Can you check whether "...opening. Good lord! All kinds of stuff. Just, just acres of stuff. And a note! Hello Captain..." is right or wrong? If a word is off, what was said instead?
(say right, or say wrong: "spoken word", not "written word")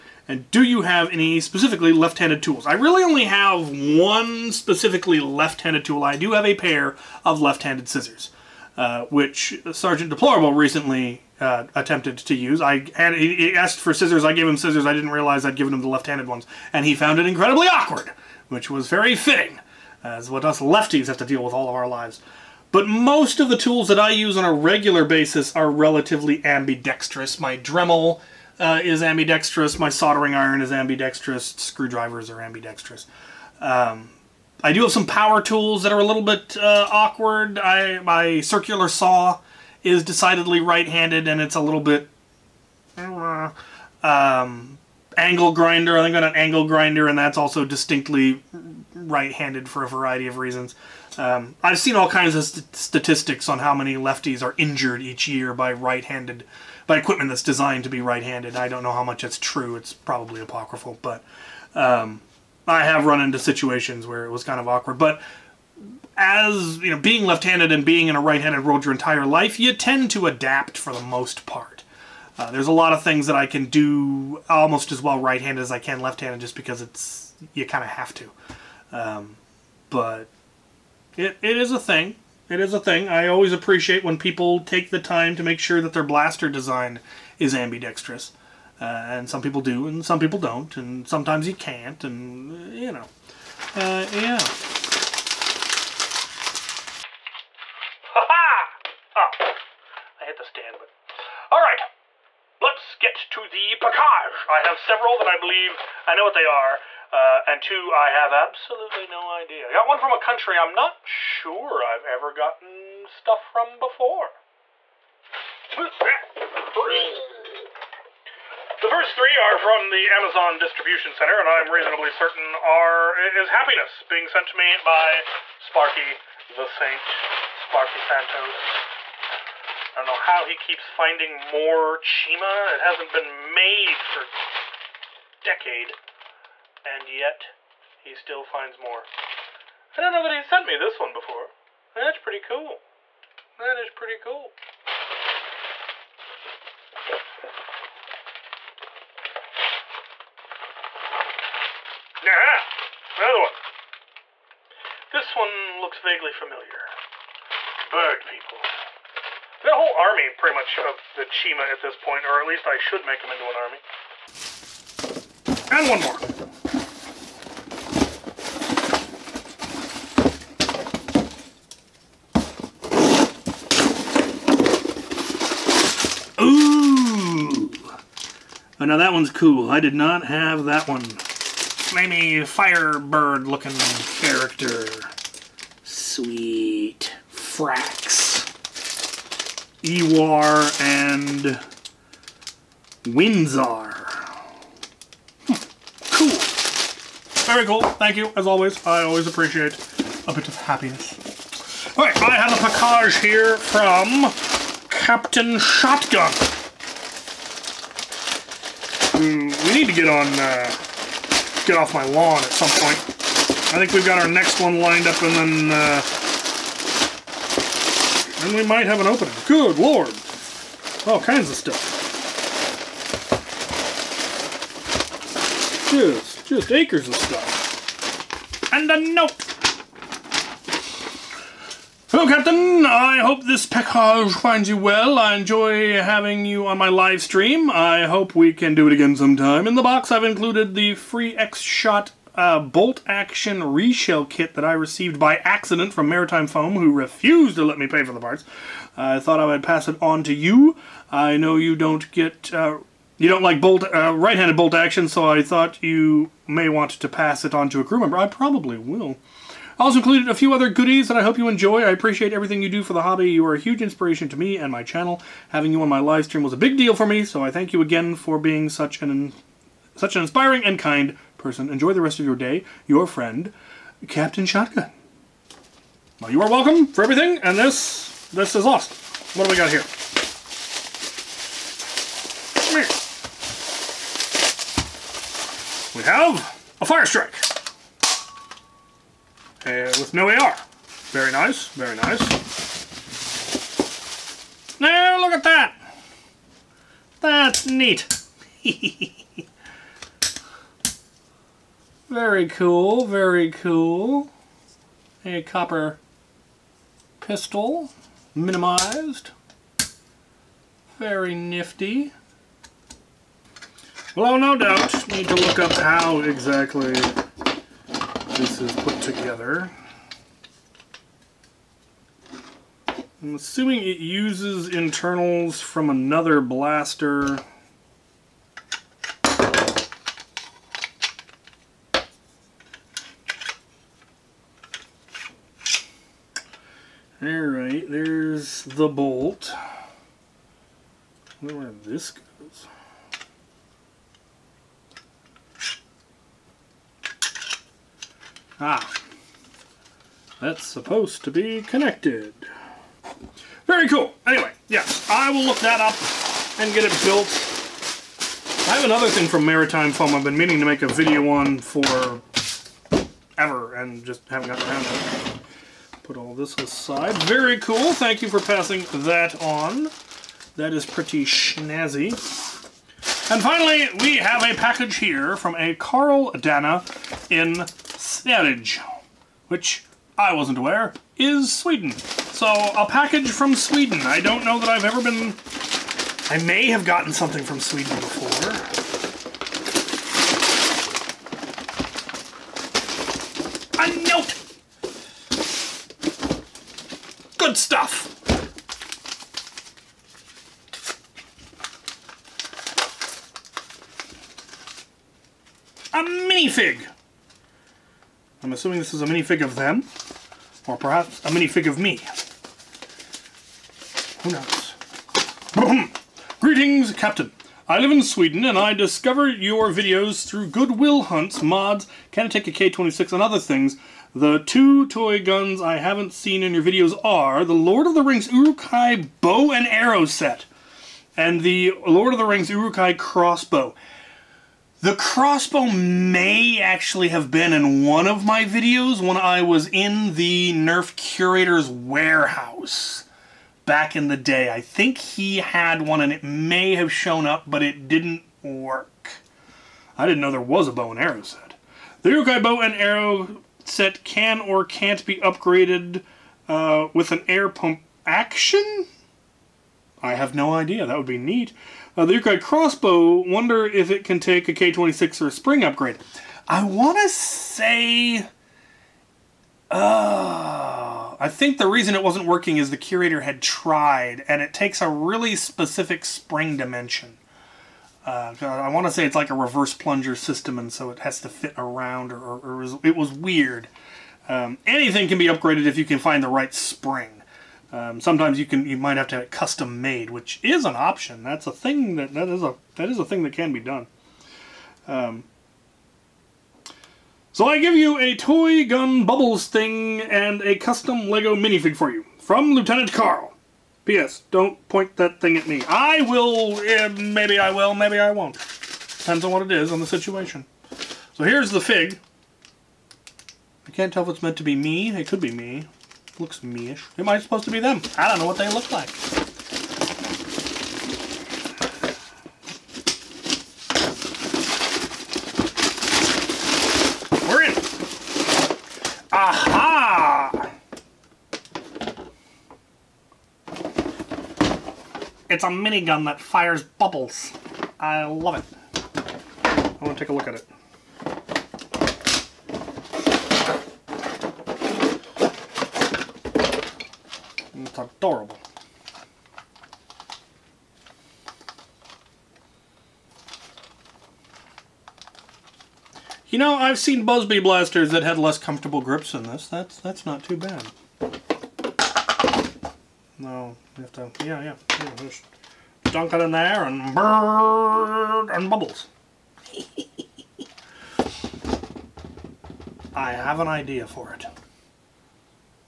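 right.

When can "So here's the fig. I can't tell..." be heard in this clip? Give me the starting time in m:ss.
8:31.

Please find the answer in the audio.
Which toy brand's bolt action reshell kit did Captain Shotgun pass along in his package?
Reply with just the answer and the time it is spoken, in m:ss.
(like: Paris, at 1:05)
X-Shot, at 4:01.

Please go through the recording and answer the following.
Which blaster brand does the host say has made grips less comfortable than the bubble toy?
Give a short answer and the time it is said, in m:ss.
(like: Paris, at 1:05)
Buzz Bee, at 9:17.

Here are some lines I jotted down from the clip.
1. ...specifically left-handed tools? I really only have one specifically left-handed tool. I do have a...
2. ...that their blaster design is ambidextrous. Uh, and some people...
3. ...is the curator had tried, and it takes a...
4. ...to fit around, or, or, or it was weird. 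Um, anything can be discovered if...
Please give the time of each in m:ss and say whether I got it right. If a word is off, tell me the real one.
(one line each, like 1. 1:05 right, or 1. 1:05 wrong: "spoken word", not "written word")
1. 0:01 right
2. 1:25 right
3. 7:52 right
4. 8:01 wrong: "upgraded", not "discovered".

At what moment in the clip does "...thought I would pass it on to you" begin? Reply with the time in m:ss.
4:09.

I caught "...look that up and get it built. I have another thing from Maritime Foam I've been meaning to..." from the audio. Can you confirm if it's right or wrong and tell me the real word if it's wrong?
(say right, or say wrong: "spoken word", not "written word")
right.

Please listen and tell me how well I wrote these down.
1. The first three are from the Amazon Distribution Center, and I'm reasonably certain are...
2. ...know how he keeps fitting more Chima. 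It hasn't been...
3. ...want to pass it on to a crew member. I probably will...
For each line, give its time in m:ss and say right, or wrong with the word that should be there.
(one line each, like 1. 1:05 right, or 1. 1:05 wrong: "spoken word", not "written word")
1. 1:55 right
2. 2:10 wrong: "finding", not "fitting"
3. 4:16 right.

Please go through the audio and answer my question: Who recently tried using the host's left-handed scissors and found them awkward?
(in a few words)
Sergeant Deplorable.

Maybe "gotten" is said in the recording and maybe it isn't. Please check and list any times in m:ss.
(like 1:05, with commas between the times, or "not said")
1:52, 6:04, 6:26.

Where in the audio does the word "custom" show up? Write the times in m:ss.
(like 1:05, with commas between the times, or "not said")
8:09, 8:20.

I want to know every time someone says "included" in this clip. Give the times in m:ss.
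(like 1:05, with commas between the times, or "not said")
4:00, 4:19.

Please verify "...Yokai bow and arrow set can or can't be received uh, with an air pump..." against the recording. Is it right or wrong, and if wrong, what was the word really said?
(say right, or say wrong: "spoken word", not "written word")
wrong: "upgraded", not "received".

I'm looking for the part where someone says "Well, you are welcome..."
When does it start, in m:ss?
4:36.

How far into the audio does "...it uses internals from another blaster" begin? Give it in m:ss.
5:23.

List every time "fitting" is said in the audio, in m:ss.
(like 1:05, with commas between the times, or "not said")
0:19.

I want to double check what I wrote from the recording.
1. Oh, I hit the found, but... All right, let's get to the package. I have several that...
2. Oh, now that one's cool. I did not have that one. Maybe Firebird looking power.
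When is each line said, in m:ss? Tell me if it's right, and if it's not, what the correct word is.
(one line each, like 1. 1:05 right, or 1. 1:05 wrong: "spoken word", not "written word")
1. 1:39 wrong: "stand", not "found"
2. 2:58 wrong: "character", not "power".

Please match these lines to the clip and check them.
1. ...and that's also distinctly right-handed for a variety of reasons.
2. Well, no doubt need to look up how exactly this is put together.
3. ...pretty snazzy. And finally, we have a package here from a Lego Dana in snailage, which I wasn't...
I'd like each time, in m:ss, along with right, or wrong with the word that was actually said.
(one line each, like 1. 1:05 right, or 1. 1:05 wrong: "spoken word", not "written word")
1. 0:47 right
2. 5:14 right
3. 6:10 wrong: "Carl", not "Lego".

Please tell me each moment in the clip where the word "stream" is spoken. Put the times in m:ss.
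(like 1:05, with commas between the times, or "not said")
3:57, 4:26.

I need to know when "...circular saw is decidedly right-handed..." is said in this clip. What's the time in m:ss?
0:38.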